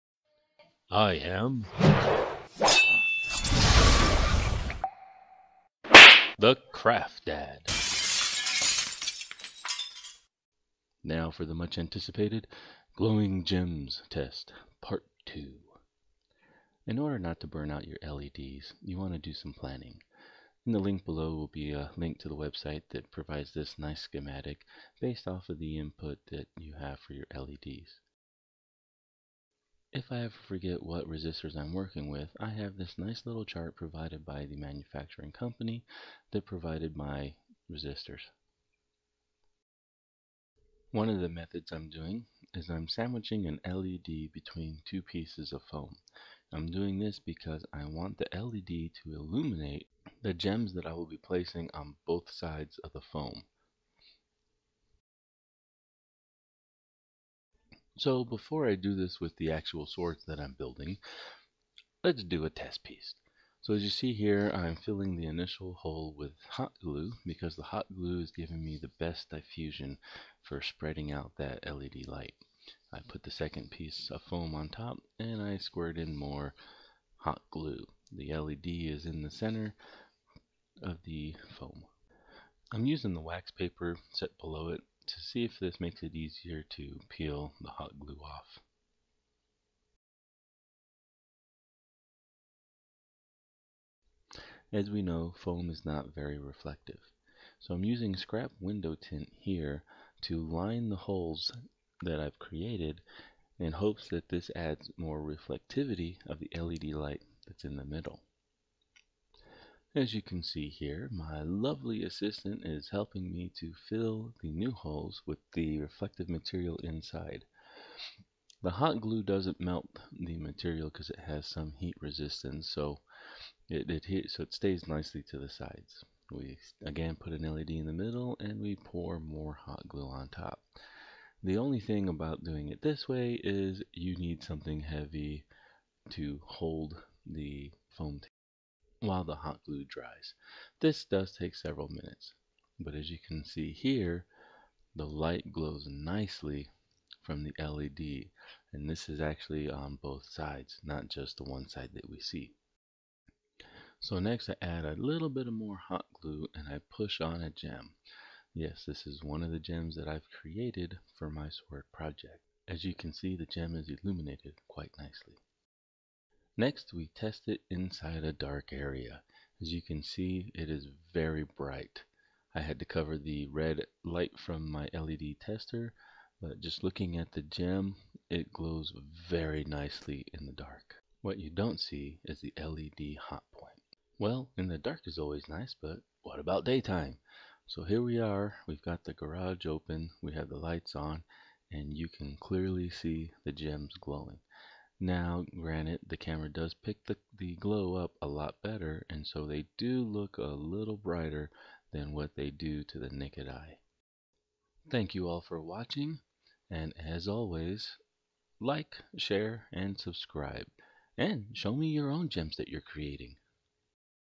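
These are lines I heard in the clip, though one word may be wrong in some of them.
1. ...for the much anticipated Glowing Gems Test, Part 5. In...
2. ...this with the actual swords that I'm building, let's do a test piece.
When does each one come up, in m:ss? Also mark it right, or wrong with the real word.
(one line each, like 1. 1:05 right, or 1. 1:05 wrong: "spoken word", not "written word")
1. 0:11 wrong: "2", not "5"
2. 0:58 right.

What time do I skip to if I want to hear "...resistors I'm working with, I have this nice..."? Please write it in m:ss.
0:31.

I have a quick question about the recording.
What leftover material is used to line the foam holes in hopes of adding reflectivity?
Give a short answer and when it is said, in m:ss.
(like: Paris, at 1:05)
scrap window tint, at 1:38.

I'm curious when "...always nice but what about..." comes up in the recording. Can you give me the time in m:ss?
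3:05.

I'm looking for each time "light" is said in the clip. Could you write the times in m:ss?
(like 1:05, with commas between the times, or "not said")
1:12, 1:46, 2:25, 2:54, 3:10.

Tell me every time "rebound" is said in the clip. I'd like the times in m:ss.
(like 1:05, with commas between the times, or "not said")
not said.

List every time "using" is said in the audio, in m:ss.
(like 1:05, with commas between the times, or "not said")
1:22, 1:37.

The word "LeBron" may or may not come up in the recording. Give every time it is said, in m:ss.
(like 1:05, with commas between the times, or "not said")
not said.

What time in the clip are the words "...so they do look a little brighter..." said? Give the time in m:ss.
3:19.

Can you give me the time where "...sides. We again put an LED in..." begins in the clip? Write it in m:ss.
2:05.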